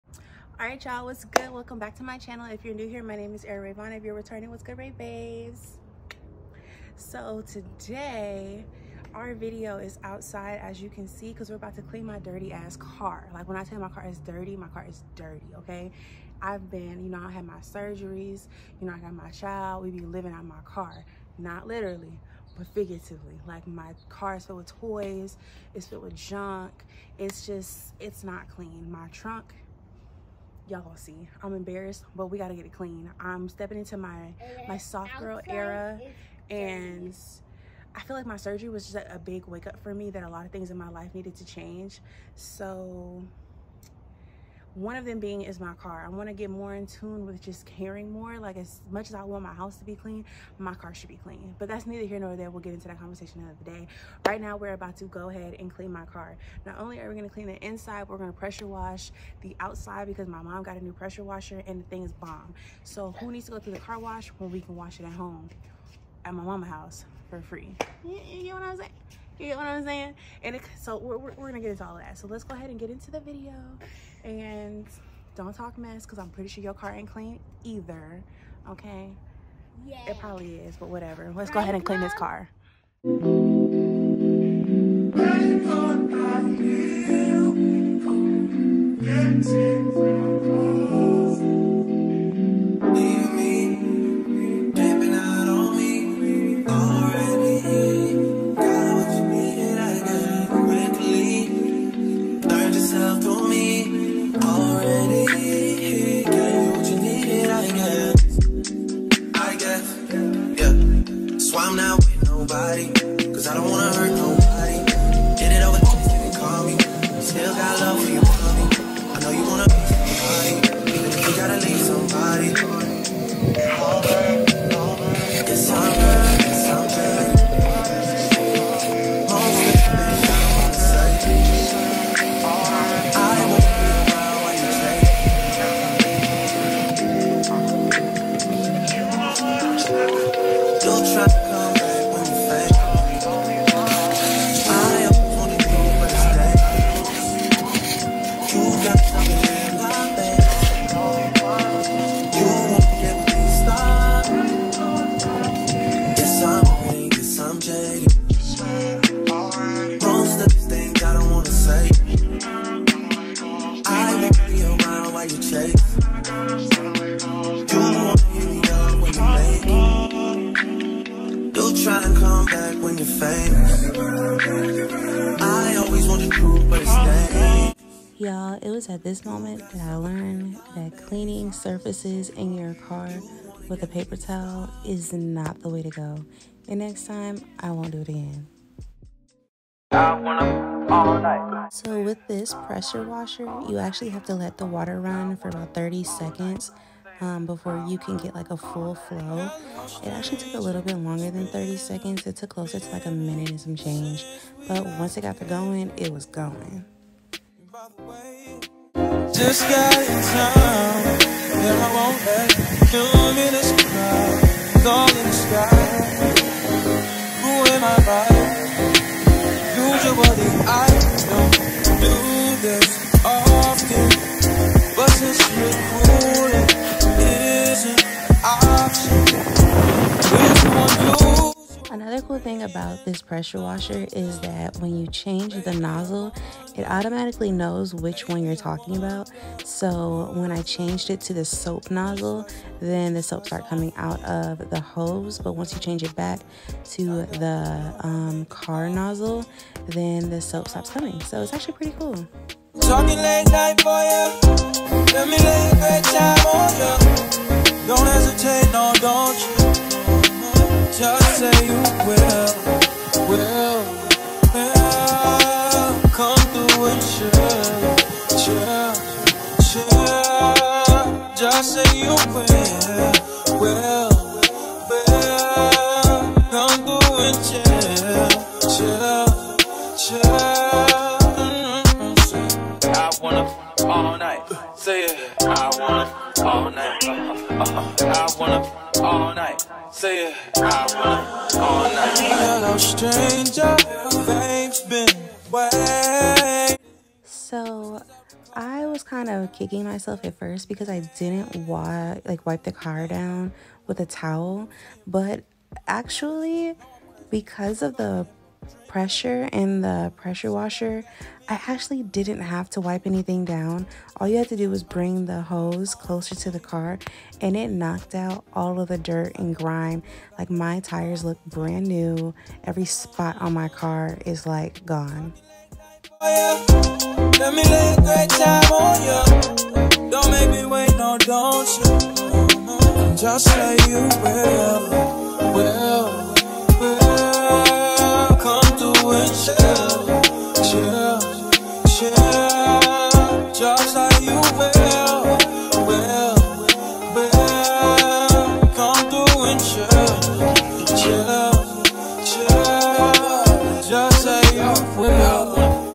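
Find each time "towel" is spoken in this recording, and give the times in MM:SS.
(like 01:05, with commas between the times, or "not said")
03:04, 05:04.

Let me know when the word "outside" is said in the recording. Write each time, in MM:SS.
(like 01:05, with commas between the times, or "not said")
00:10, 00:59.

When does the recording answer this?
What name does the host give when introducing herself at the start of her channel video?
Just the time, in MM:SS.
00:03.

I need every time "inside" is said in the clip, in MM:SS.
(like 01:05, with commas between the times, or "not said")
00:57.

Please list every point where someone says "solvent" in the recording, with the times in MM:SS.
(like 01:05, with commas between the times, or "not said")
not said.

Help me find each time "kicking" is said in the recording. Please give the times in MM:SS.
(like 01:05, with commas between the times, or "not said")
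04:59.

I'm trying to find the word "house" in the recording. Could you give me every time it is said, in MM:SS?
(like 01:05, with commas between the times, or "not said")
00:49, 01:06.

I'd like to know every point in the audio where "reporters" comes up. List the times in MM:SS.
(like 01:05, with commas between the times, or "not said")
not said.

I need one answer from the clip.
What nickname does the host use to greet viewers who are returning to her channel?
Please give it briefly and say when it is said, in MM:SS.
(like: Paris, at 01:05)
Ray babes, at 00:04.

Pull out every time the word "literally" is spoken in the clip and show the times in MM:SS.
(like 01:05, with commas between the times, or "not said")
00:21.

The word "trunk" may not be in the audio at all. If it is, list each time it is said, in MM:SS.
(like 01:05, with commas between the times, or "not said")
00:29.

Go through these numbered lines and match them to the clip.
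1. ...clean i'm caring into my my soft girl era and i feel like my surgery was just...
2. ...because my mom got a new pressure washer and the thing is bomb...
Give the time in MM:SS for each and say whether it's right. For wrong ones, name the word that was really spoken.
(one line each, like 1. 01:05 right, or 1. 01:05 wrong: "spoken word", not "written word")
1. 00:32 wrong: "stepping", not "caring"
2. 01:00 right.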